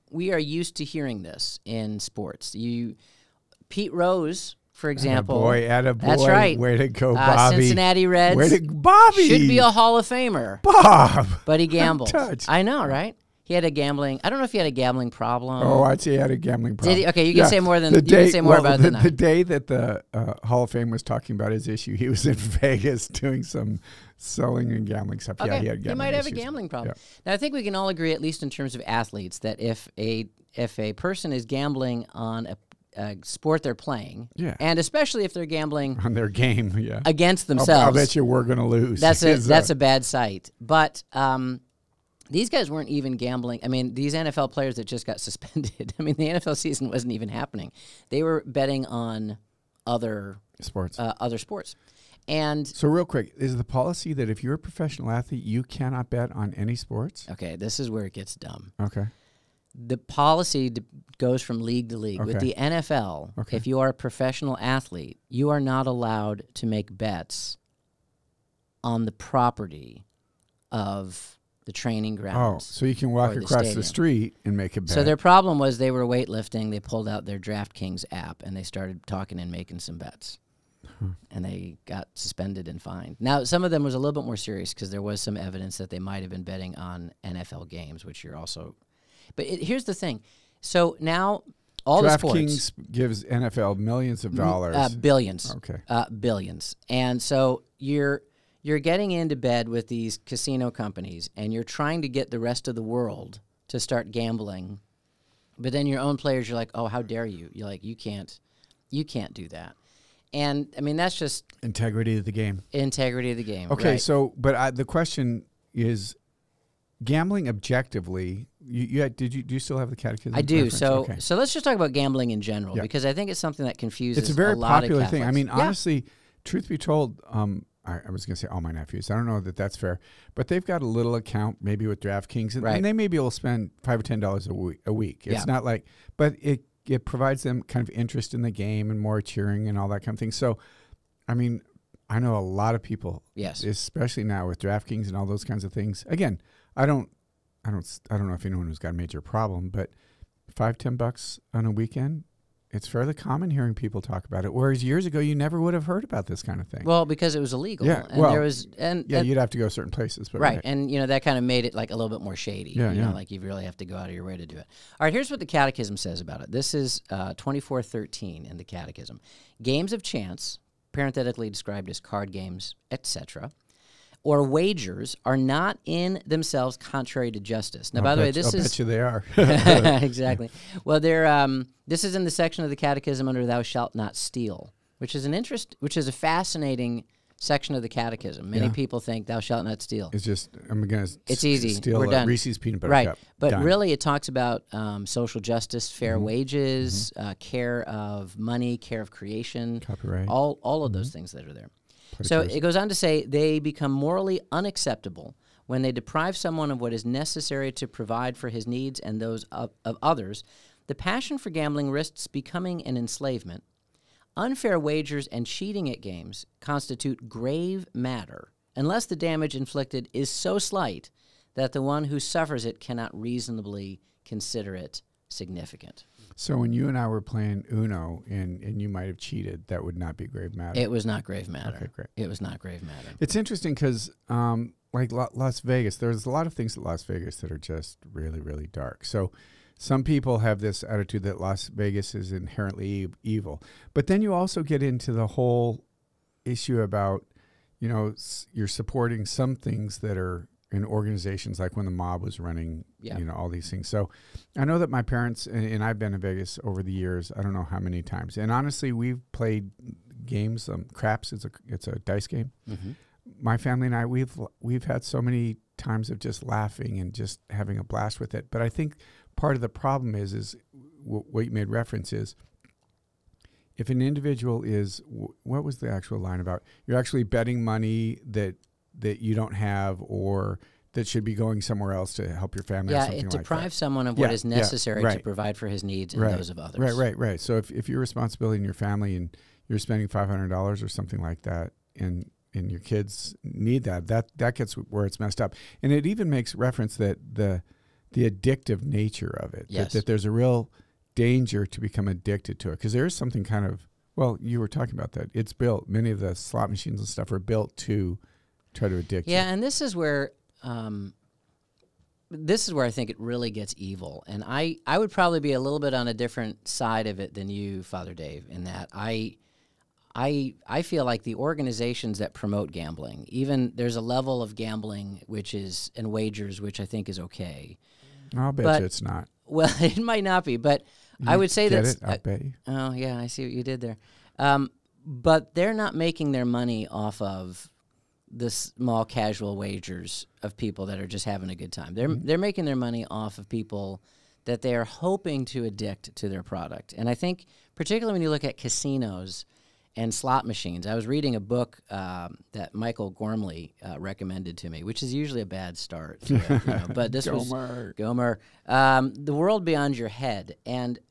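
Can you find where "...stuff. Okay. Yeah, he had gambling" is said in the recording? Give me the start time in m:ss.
0:25.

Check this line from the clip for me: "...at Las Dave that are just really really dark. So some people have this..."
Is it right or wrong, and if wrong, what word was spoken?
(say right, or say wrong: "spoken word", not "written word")
wrong: "Vegas", not "Dave".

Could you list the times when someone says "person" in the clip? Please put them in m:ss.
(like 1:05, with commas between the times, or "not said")
0:30.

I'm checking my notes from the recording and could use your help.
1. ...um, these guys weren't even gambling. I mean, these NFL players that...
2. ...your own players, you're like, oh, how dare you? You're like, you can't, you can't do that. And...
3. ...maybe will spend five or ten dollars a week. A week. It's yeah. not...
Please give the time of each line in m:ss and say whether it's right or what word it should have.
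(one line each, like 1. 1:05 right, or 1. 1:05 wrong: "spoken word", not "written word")
1. 0:41 right
2. 1:45 right
3. 2:12 right.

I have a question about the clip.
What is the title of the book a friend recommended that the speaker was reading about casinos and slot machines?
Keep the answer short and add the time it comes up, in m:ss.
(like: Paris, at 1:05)
The World Beyond Your Head, at 5:59.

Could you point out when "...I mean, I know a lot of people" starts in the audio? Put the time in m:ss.
2:21.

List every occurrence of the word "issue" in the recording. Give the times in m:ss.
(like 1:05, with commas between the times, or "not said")
0:21, 4:06.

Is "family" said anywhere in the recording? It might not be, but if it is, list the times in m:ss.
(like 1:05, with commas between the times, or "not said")
4:23, 4:42, 4:48.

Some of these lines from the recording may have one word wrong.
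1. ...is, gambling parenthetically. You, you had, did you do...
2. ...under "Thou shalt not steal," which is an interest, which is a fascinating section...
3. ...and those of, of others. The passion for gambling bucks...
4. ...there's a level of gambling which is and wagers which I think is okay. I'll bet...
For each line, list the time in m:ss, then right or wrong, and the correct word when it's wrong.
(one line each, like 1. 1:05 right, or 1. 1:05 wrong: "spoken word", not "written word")
1. 1:55 wrong: "objectively", not "parenthetically"
2. 3:03 right
3. 3:28 wrong: "risks", not "bucks"
4. 5:23 right.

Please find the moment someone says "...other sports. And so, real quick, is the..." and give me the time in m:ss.
0:51.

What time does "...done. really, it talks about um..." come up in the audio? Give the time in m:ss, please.
3:13.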